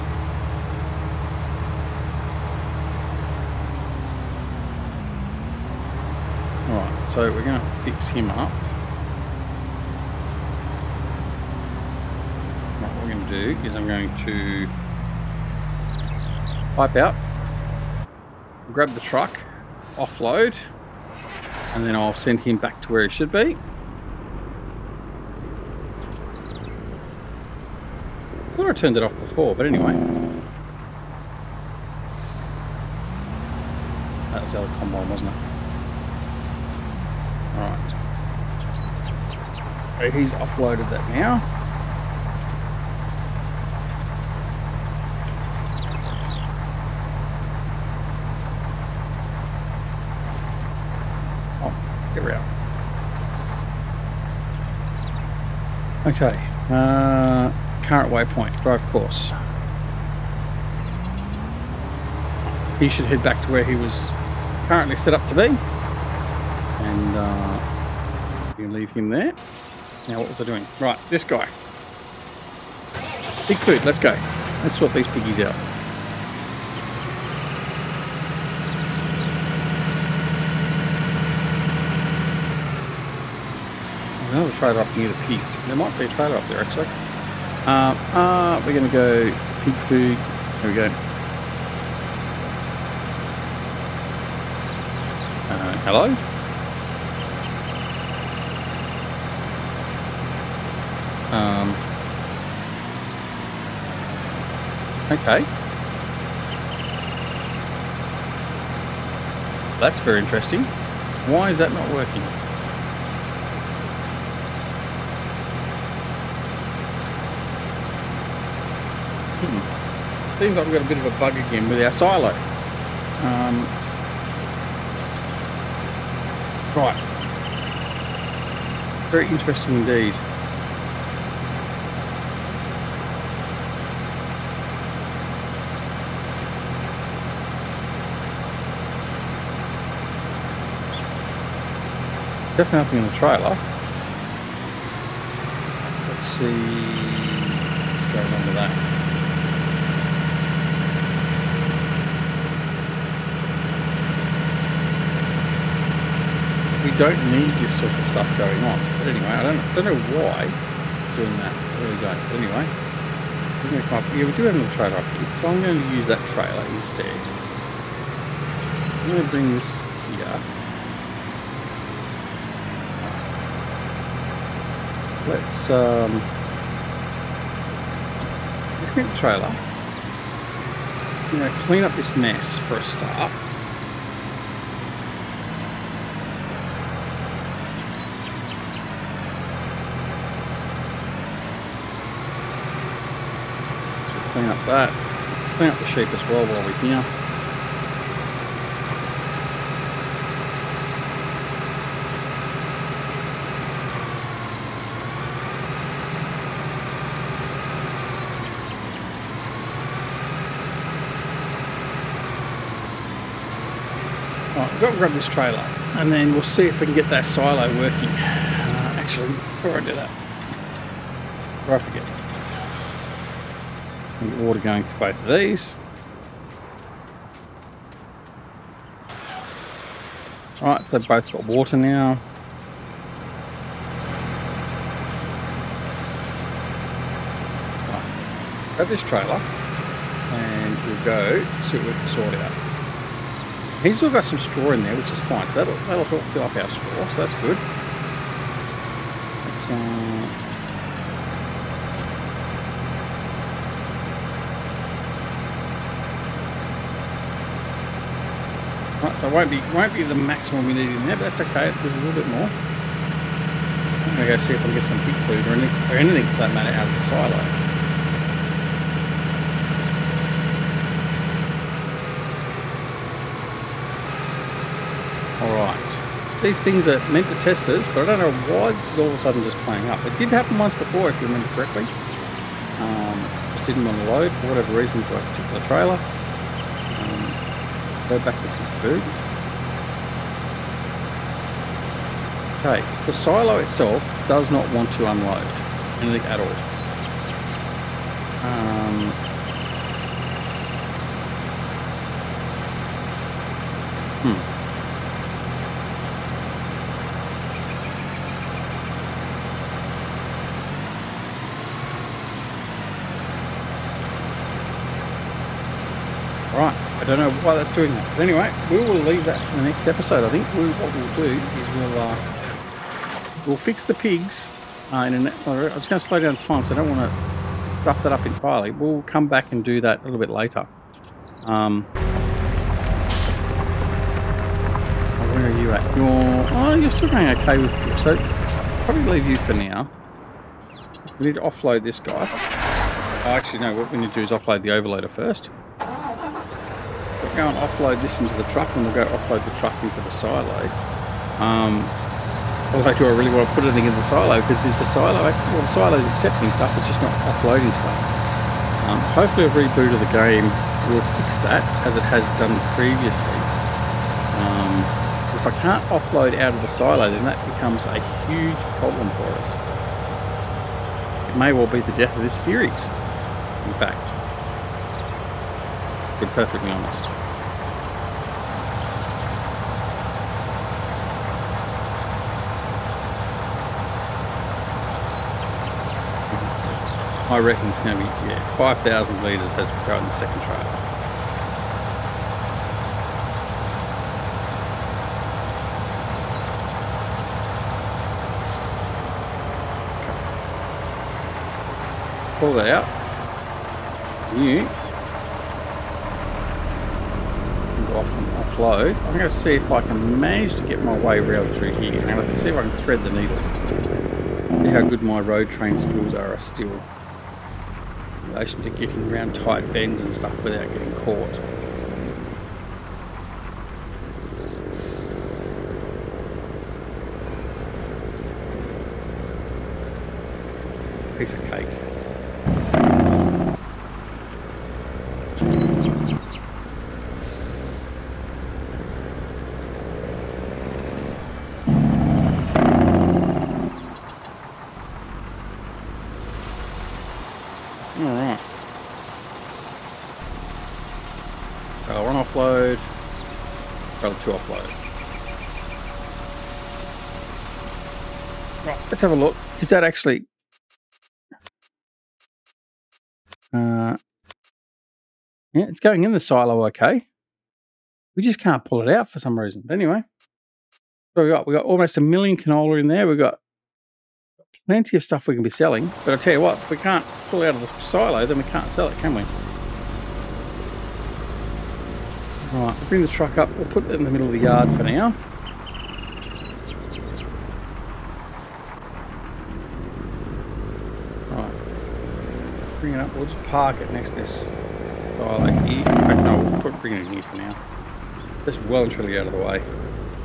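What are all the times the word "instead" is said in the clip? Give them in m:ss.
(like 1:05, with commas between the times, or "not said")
2:46.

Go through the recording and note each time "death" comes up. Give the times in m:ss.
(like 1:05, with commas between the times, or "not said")
6:11.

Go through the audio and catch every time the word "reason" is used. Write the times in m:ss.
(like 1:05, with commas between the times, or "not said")
4:44, 7:49.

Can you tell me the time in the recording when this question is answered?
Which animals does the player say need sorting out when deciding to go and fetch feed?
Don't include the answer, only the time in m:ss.
1:15.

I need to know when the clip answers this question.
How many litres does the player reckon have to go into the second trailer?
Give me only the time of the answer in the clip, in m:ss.
6:28.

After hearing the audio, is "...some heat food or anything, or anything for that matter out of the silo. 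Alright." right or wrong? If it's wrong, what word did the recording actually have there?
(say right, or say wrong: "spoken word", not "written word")
right.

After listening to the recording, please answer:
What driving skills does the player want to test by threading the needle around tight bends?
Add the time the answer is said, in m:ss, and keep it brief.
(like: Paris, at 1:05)
Road train skills, at 6:55.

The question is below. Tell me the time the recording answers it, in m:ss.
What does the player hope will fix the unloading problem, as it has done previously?
5:59.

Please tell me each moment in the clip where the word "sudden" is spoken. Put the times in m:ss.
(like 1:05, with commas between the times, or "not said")
4:39.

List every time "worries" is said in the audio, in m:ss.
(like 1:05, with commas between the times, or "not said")
not said.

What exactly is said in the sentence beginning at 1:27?
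Um, uh, we're going to go pig food.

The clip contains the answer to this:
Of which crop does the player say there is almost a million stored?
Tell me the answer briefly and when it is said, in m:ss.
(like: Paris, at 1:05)
Canola, at 7:52.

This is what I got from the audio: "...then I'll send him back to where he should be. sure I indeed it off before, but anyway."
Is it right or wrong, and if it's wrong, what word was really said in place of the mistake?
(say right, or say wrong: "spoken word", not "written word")
wrong: "turned", not "indeed".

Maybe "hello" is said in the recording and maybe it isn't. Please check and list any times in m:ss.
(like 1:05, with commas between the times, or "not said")
1:35.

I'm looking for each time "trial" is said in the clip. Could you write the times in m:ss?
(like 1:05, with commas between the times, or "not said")
6:30.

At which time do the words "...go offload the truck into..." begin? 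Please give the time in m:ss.
5:48.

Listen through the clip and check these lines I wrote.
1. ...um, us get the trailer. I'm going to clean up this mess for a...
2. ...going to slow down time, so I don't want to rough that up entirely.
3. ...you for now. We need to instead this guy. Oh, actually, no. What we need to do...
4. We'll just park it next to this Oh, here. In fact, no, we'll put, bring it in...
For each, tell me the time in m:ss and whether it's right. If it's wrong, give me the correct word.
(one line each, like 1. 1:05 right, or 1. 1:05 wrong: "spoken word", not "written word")
1. 2:55 right
2. 5:25 right
3. 5:39 wrong: "offload", not "instead"
4. 8:13 right.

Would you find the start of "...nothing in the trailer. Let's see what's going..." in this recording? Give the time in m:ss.
2:22.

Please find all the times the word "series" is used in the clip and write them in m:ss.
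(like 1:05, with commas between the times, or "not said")
6:12.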